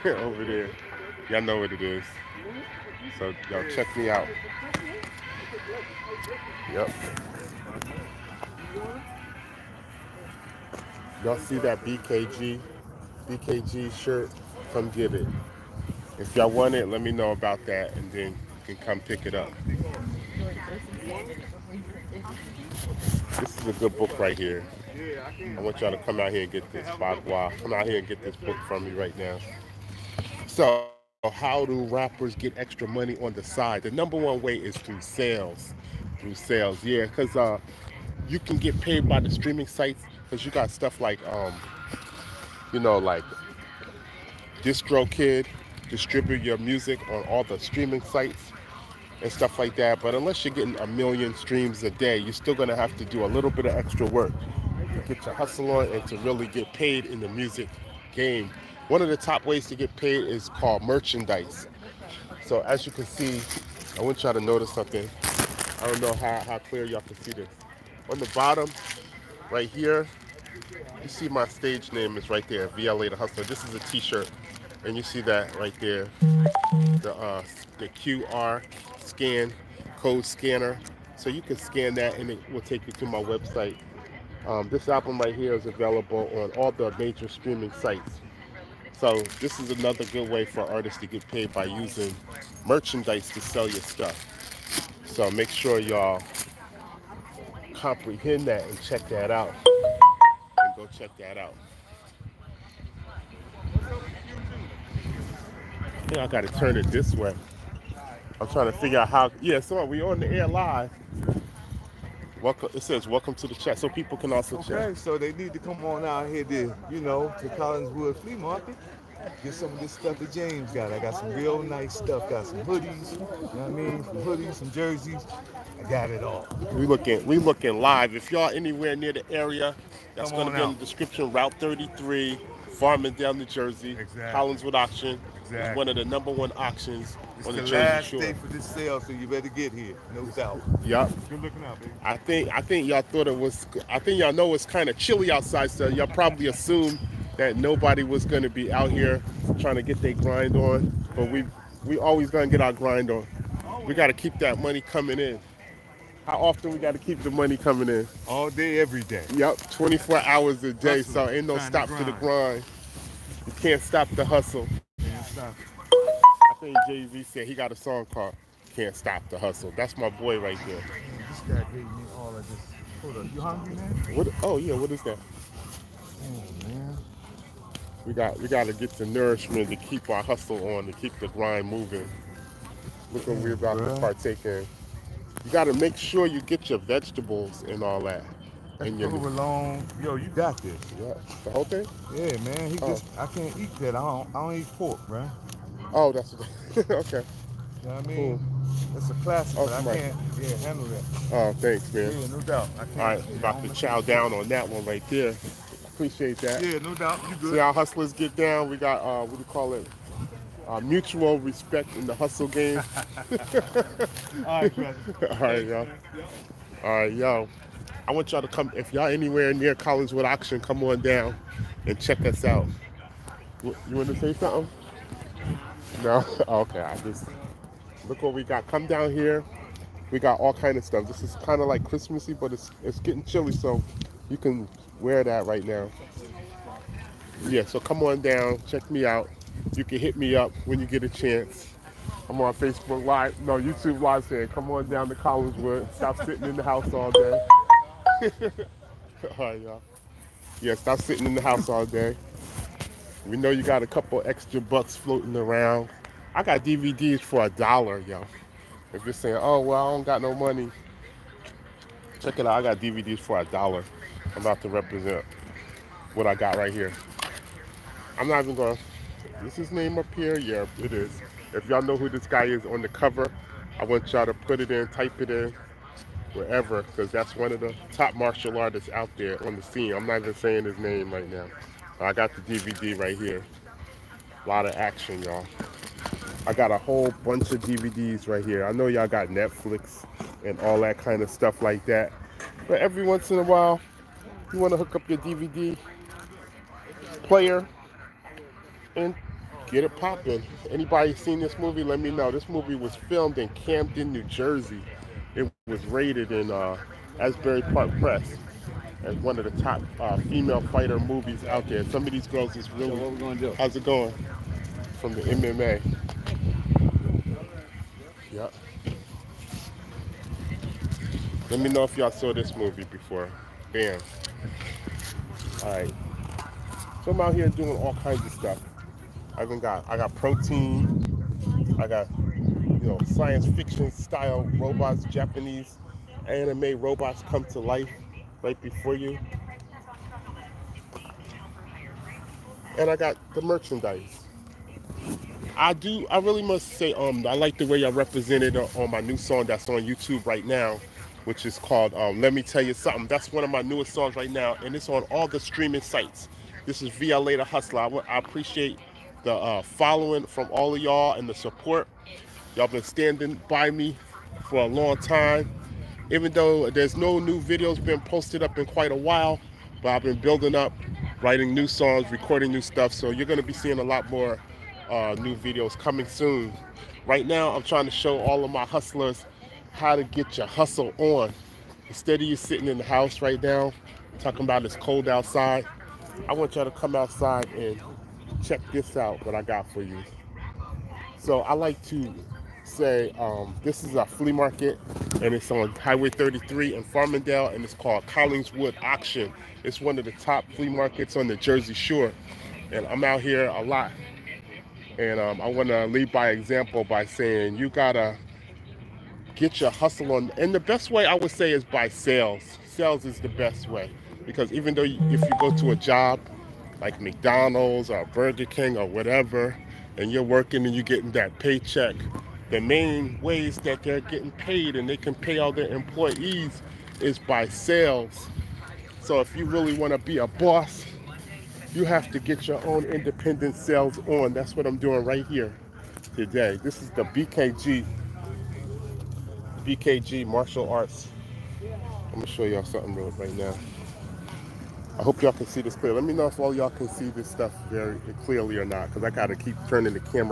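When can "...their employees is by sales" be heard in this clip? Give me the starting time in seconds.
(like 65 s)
425 s.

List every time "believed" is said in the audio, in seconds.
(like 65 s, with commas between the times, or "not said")
not said.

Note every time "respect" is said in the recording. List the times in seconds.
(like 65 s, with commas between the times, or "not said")
211 s.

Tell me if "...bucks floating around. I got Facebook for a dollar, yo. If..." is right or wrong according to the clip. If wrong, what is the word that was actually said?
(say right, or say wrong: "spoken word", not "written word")
wrong: "DVDs", not "Facebook".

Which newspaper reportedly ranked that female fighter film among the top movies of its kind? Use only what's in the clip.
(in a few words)
Asbury Park Press.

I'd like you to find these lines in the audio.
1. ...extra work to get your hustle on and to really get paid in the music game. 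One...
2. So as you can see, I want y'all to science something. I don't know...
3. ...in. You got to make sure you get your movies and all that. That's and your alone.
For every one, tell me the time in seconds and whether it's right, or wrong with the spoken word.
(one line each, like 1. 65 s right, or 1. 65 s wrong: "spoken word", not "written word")
1. 53 s right
2. 62 s wrong: "notice", not "science"
3. 184 s wrong: "vegetables", not "movies".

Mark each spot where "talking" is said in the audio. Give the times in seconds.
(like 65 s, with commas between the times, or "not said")
384 s.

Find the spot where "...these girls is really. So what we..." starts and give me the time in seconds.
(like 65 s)
312 s.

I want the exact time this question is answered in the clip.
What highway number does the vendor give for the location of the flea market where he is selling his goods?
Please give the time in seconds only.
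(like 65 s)
131 s.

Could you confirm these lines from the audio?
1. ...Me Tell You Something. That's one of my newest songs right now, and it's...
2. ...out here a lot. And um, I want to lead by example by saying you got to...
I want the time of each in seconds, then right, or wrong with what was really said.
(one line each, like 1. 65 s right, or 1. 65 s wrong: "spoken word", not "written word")
1. 352 s right
2. 403 s right.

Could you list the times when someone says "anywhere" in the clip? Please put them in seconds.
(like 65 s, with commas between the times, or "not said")
128 s, 219 s.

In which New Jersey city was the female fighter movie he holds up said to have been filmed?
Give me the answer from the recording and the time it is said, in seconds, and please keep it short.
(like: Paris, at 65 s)
Camden, at 303 s.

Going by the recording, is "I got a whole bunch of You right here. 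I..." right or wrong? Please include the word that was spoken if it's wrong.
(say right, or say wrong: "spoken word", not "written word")
wrong: "DVDs", not "You".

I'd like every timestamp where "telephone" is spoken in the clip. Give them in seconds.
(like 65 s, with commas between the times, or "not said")
not said.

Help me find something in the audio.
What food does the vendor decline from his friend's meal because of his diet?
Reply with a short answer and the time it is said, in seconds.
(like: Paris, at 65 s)
Pork, at 194 s.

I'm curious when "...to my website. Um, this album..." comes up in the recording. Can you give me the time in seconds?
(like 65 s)
82 s.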